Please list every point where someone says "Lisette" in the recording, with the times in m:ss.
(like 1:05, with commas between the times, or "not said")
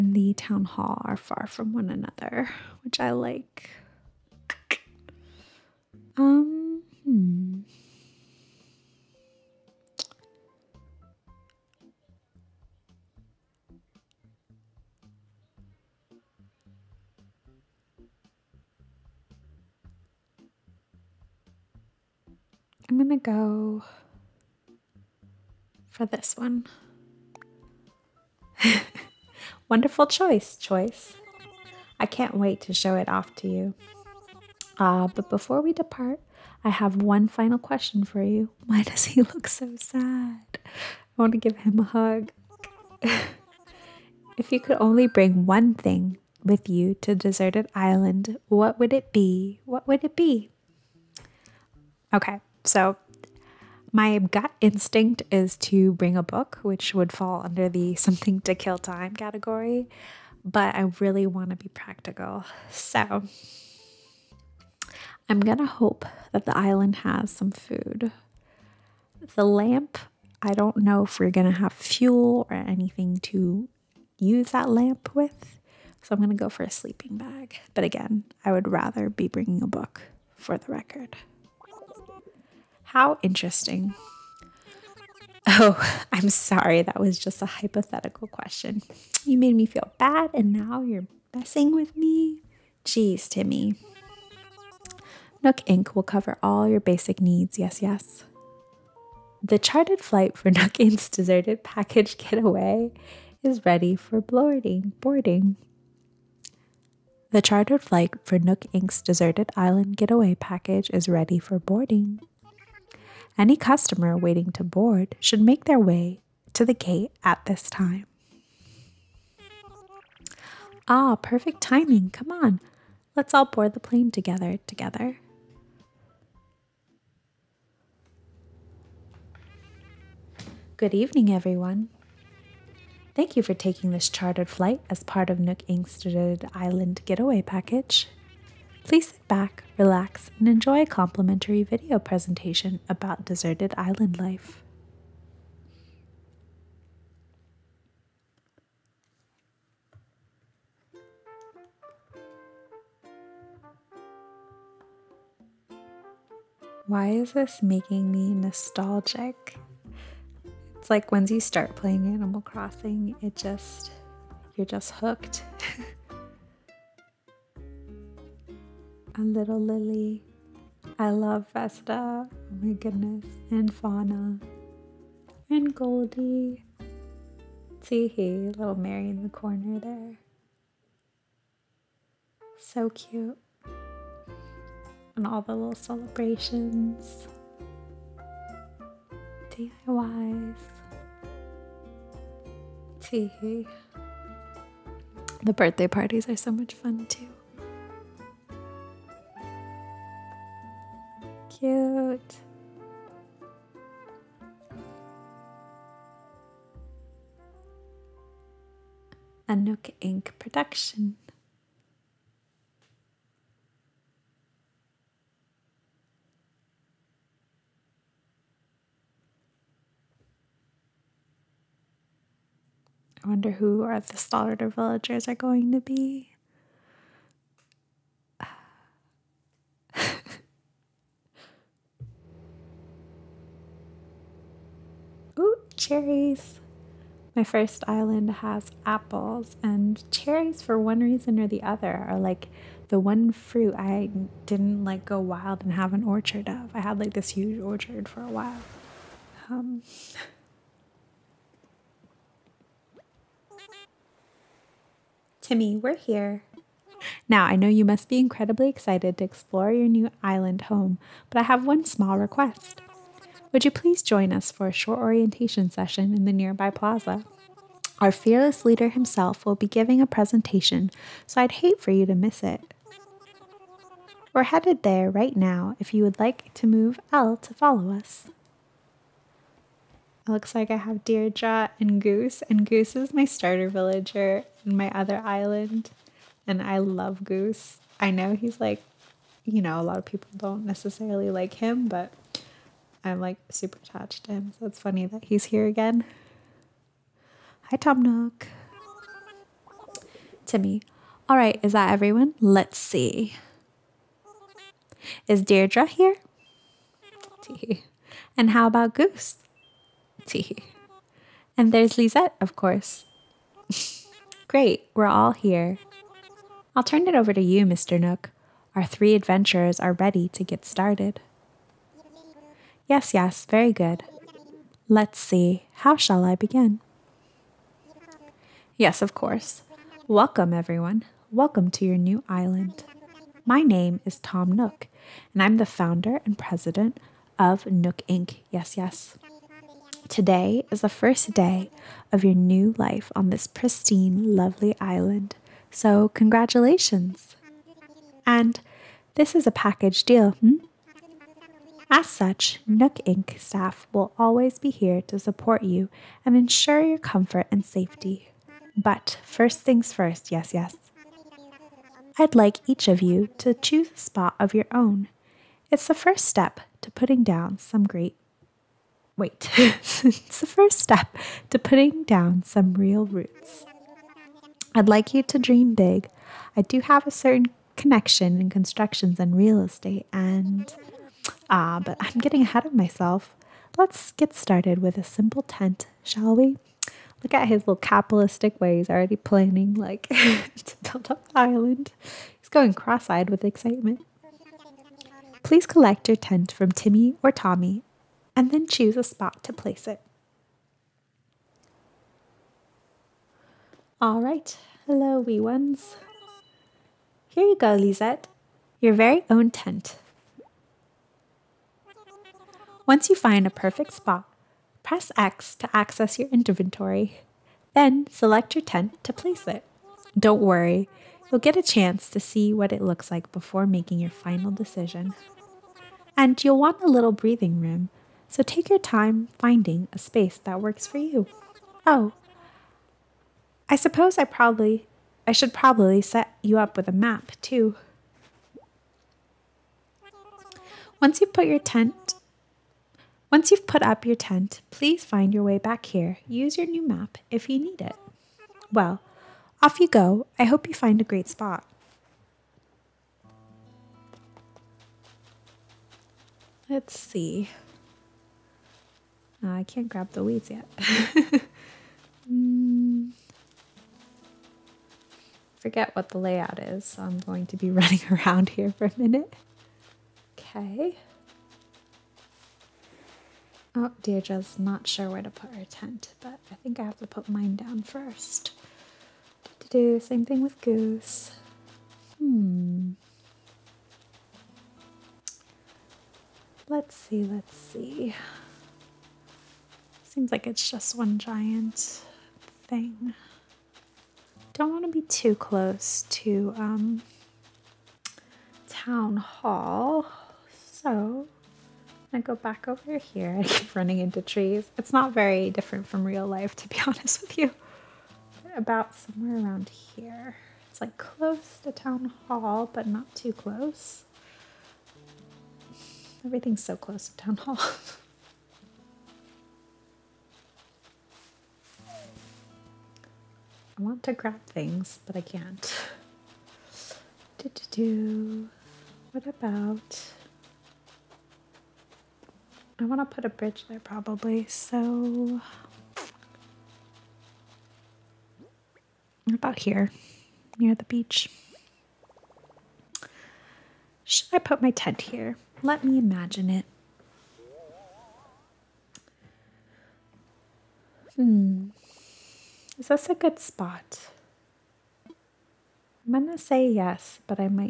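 5:11, 6:47.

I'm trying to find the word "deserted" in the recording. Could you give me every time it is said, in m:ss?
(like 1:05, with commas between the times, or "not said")
0:47, 1:41, 1:49, 2:23.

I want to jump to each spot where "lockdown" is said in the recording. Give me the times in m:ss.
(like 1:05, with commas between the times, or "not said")
not said.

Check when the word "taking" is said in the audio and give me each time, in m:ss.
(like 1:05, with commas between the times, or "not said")
2:13.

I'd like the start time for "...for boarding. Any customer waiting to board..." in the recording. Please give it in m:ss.
1:51.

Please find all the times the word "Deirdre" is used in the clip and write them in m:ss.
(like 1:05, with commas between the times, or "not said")
4:41, 5:05, 7:54.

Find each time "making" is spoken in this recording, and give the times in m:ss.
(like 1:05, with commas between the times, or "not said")
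2:37, 7:03.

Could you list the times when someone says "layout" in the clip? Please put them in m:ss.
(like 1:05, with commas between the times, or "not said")
7:46.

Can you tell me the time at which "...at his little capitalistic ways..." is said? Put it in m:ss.
6:27.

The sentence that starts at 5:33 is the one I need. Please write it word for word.
My name is Tom Nook, and I'm the founder and president of Nook Inc.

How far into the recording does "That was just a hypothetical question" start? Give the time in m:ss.
1:26.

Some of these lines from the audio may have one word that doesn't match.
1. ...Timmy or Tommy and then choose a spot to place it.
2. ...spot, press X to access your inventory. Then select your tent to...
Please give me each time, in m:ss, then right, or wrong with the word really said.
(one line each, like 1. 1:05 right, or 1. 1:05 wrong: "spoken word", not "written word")
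1. 6:36 right
2. 6:53 right.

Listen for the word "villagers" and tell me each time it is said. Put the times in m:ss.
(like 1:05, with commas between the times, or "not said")
3:44, 4:43.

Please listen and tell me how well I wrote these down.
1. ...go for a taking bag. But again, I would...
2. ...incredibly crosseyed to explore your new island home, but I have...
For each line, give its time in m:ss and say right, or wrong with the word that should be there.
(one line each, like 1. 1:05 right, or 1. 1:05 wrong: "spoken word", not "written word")
1. 1:16 wrong: "sleeping", not "taking"
2. 4:18 wrong: "excited", not "crosseyed".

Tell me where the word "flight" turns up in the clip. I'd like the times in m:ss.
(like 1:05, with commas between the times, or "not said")
1:40, 1:47, 2:14.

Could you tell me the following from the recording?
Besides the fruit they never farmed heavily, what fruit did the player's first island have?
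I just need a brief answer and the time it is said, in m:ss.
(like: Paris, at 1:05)
Apples, at 3:58.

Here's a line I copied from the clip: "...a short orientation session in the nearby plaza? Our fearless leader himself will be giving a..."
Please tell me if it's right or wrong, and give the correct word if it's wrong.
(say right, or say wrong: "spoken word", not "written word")
right.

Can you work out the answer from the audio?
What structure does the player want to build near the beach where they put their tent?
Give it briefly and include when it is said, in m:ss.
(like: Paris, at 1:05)
A bridge, at 8:53.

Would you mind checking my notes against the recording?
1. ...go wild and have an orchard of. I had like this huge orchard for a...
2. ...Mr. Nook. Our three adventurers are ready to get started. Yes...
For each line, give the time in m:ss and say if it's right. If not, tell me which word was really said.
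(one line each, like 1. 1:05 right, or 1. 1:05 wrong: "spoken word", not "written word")
1. 4:05 right
2. 5:17 right.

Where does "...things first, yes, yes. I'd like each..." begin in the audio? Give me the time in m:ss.
5:59.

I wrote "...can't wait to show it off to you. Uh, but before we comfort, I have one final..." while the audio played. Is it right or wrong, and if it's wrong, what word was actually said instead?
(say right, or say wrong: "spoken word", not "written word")
wrong: "depart", not "comfort".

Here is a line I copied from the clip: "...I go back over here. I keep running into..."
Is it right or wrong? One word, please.
right.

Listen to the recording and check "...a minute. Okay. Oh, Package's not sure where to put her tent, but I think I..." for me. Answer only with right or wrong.
wrong.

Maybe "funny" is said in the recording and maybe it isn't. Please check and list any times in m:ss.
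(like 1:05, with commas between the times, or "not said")
4:54.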